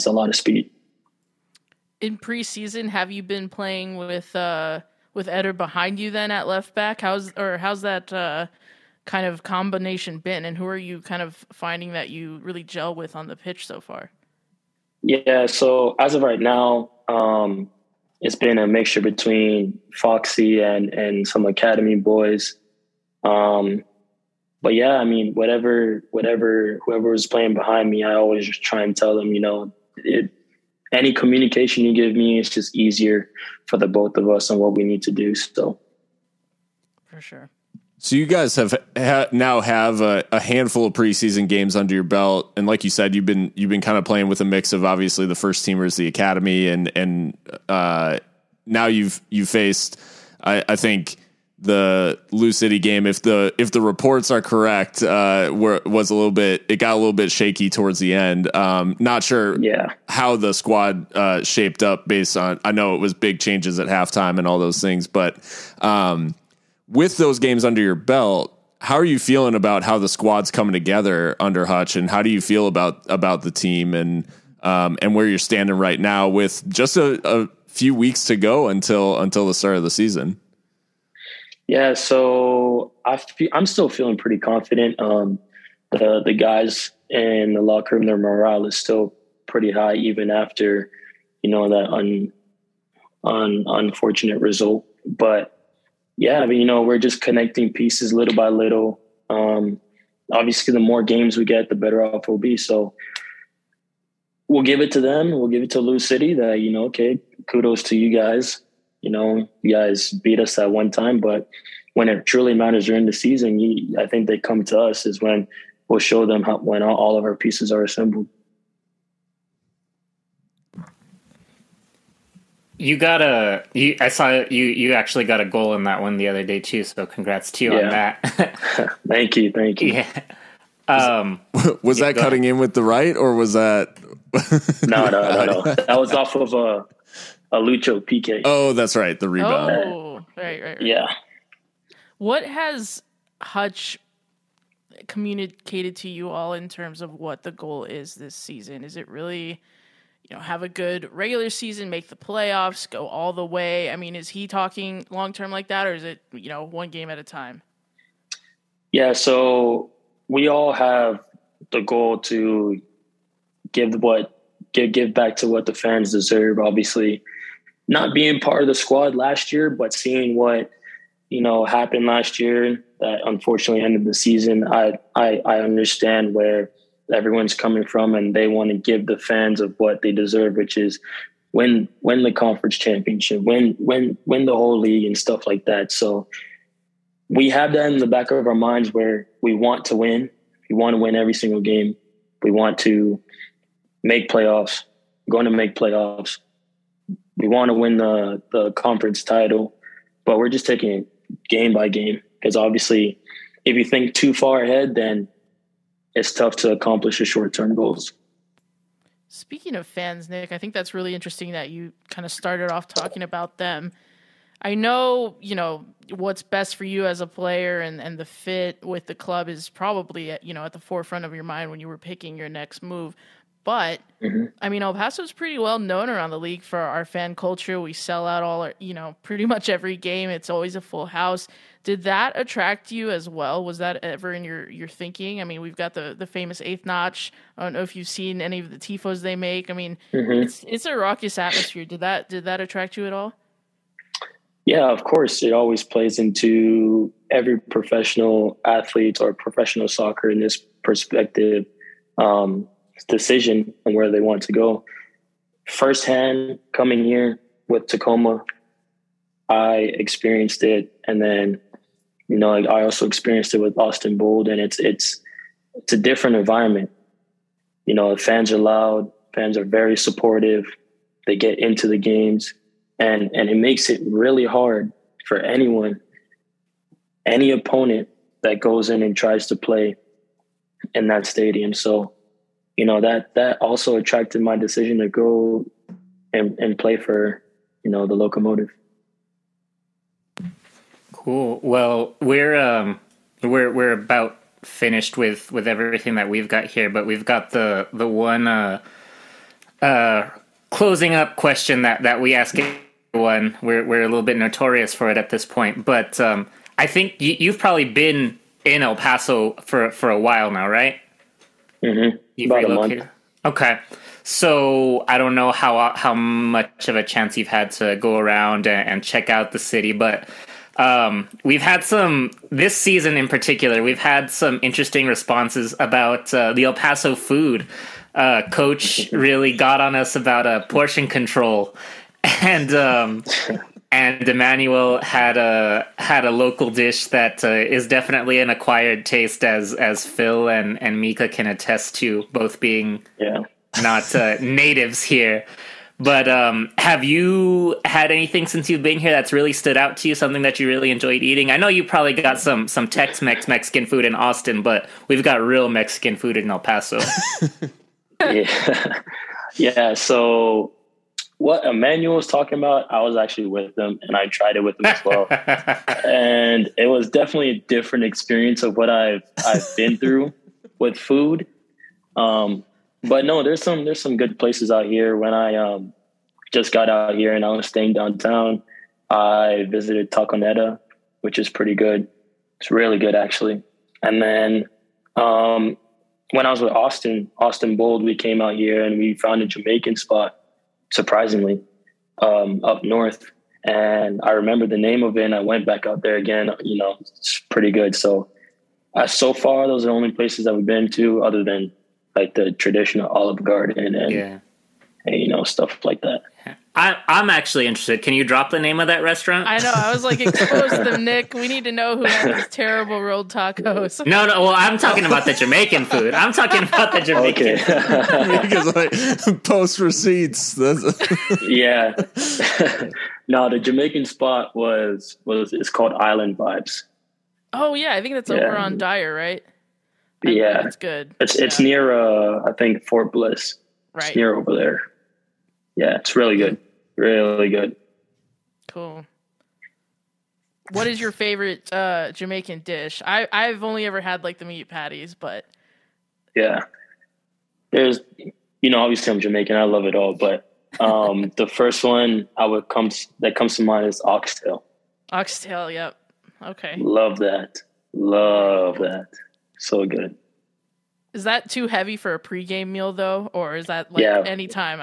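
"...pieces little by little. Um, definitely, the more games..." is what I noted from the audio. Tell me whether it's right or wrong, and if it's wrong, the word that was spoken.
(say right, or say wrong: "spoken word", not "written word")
wrong: "obviously", not "definitely".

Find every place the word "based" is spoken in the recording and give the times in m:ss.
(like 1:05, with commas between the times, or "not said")
1:02.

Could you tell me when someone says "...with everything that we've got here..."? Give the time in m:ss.
4:55.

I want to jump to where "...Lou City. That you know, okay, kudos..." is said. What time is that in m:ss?
1:45.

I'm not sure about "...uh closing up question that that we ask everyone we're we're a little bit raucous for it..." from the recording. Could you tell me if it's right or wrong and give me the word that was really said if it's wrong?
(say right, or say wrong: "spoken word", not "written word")
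wrong: "notorious", not "raucous".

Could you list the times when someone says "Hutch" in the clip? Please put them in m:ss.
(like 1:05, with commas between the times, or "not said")
1:11, 2:23.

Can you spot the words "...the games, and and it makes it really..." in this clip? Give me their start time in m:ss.
4:31.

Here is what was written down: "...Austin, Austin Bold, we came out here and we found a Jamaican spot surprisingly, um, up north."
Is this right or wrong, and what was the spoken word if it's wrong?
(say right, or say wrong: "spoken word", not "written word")
right.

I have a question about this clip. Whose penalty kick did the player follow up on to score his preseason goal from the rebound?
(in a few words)
Lucho.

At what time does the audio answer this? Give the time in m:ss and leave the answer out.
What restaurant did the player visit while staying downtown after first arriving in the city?
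6:20.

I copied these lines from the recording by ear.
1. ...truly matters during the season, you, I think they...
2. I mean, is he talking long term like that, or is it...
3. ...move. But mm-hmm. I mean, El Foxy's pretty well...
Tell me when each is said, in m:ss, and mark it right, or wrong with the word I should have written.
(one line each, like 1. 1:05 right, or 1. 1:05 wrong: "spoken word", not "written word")
1. 1:52 right
2. 2:33 right
3. 3:42 wrong: "Paso", not "Foxy".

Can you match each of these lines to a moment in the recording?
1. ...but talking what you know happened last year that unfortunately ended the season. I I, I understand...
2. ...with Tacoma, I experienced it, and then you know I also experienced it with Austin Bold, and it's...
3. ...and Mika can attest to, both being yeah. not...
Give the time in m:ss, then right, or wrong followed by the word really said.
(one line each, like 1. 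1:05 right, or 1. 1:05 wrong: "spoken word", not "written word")
1. 2:49 wrong: "seeing", not "talking"
2. 4:17 right
3. 5:40 right.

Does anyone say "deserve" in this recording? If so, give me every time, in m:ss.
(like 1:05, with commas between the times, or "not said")
2:46, 3:00.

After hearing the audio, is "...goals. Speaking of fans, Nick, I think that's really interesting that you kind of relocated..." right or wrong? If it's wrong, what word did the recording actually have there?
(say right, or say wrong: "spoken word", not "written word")
wrong: "started", not "relocated".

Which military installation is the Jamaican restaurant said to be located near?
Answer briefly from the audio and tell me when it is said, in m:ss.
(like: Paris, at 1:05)
Fort Bliss, at 7:12.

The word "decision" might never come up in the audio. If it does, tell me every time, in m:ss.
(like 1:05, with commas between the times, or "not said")
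4:13, 4:44.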